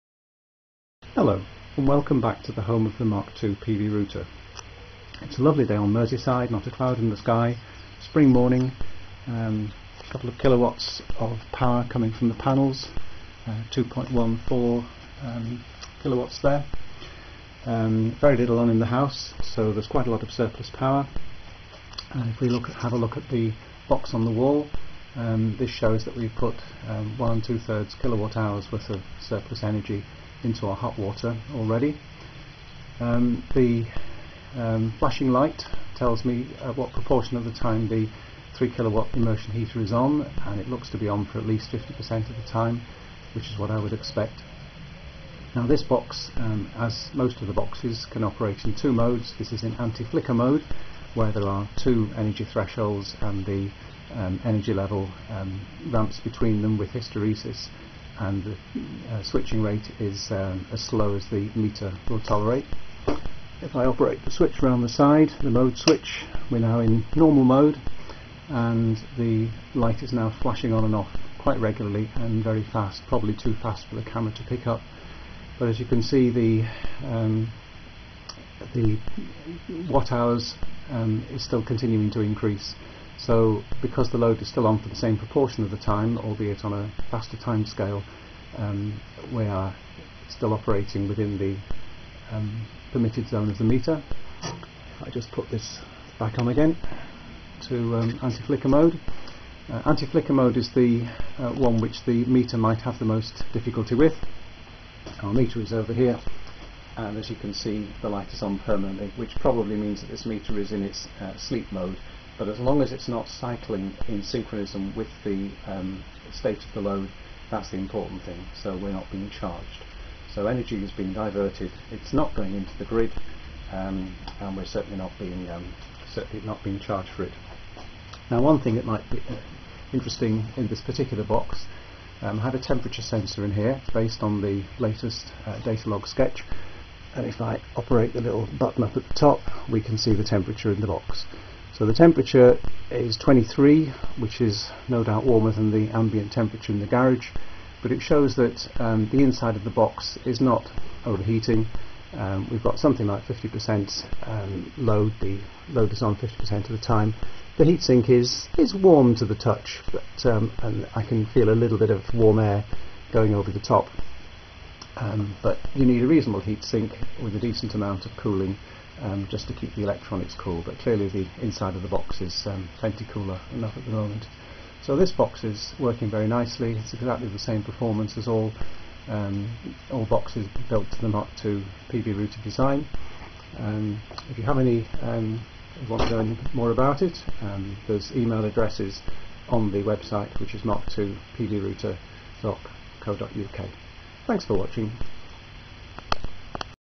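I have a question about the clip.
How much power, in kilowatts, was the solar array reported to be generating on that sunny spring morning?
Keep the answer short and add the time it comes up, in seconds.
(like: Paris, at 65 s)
2.14, at 13 s.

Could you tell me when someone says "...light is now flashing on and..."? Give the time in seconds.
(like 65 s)
69 s.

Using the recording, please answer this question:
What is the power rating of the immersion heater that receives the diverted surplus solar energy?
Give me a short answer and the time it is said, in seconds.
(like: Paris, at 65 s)
3 kilowatt, at 38 s.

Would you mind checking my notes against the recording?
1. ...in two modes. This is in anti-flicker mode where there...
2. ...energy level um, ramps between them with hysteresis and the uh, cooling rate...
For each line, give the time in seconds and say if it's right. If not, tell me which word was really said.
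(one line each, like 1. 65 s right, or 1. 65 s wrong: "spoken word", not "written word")
1. 48 s right
2. 54 s wrong: "switching", not "cooling".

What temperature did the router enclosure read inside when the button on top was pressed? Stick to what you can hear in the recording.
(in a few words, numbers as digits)
23.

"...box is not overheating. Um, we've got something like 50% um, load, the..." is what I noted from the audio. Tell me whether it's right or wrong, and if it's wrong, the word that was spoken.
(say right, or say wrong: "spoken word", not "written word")
right.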